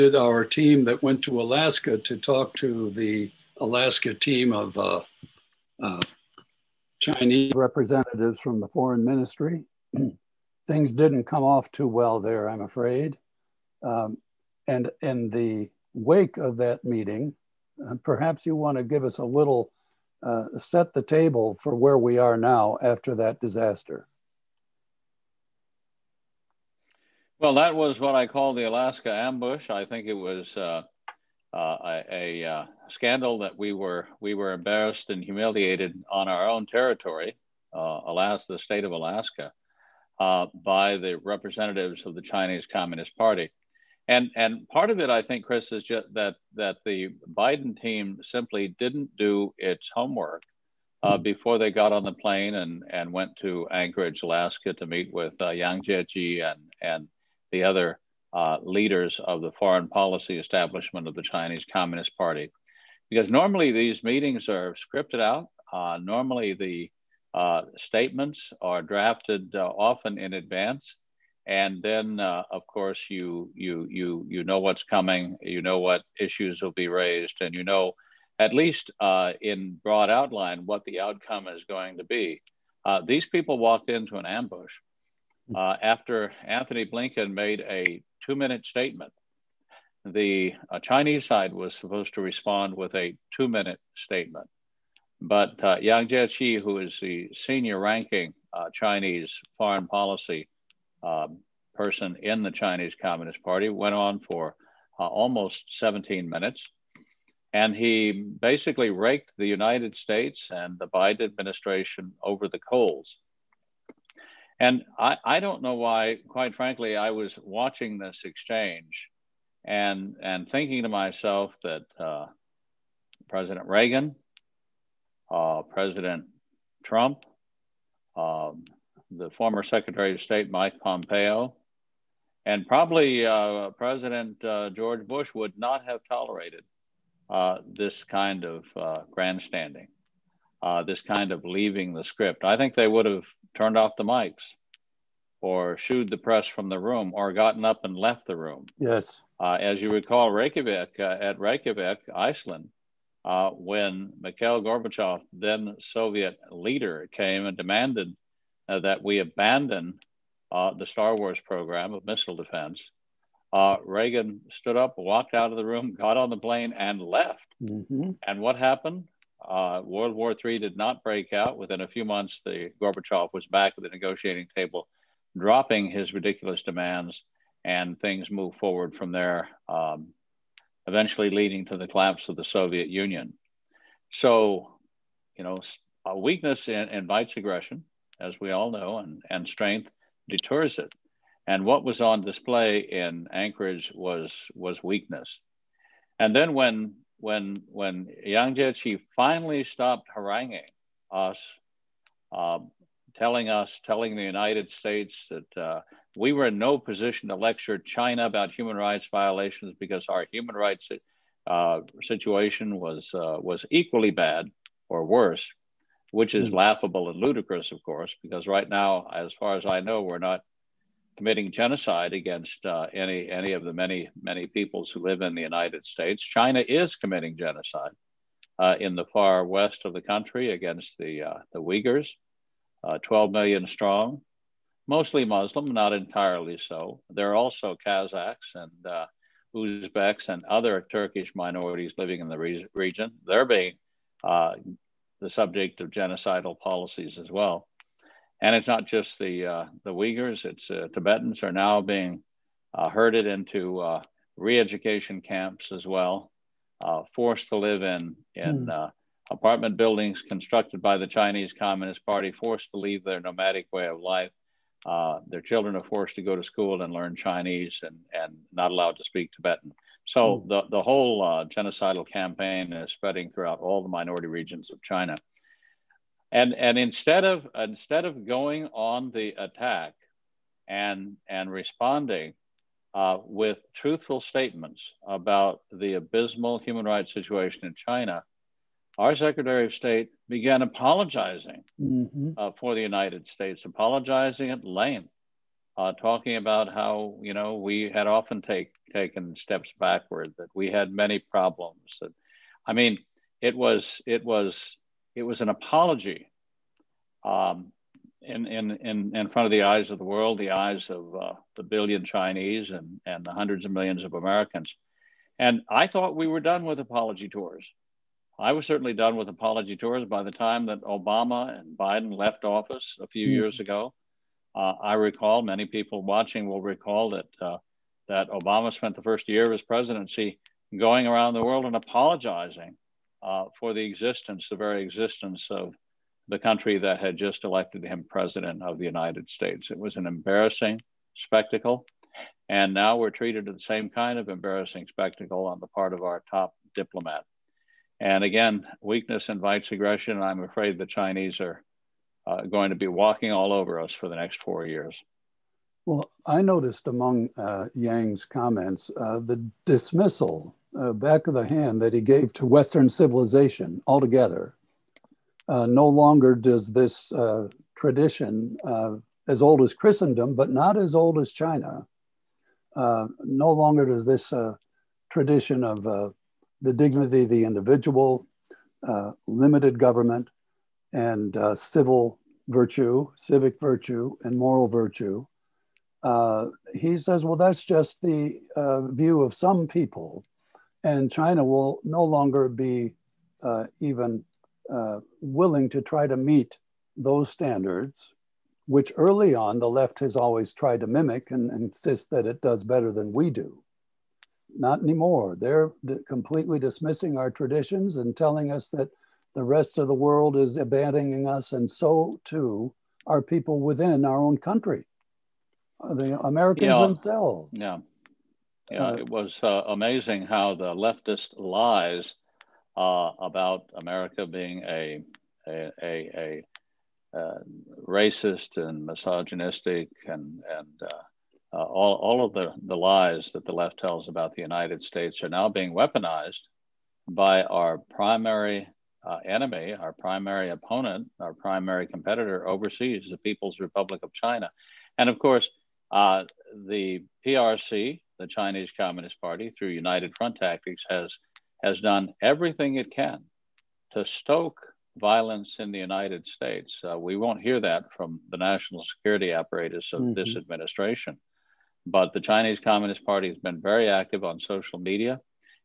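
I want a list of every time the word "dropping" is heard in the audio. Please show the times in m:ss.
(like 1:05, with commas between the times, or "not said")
2:55.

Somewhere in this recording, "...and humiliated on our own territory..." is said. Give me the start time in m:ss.
0:35.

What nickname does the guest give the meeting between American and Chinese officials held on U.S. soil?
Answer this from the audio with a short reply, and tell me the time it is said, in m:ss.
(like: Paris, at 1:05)
the Alaska ambush, at 0:28.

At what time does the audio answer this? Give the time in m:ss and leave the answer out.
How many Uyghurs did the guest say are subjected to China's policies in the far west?
3:52.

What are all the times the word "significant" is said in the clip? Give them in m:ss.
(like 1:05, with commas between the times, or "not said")
not said.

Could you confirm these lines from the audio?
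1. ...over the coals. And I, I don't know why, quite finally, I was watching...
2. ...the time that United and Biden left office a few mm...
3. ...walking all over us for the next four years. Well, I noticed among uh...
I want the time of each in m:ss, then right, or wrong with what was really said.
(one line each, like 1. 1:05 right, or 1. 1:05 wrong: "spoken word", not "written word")
1. 1:52 wrong: "frankly", not "finally"
2. 5:20 wrong: "Obama", not "United"
3. 5:52 right.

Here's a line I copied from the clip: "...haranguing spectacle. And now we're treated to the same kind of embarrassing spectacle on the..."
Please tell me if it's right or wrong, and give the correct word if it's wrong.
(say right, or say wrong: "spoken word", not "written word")
wrong: "embarrassing", not "haranguing".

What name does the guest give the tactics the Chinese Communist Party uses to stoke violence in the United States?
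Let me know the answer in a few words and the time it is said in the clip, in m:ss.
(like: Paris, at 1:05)
United Front Tactics, at 7:29.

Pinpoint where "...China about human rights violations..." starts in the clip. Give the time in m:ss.
3:27.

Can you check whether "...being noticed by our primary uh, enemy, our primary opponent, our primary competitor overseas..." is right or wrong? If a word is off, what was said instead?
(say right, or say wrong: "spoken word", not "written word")
wrong: "weaponized", not "noticed".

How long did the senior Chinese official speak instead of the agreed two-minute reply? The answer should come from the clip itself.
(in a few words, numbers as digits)
almost 17 minutes.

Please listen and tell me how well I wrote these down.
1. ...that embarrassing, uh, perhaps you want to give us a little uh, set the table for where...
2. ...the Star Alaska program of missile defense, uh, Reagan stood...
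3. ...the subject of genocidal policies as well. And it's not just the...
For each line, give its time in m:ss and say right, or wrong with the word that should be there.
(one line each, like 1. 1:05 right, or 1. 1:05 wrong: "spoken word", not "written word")
1. 0:16 wrong: "meeting", not "embarrassing"
2. 2:40 wrong: "Wars", not "Alaska"
3. 4:05 right.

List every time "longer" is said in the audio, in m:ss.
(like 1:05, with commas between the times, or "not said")
6:05, 6:13, 6:32.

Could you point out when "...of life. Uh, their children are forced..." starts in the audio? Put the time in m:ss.
4:23.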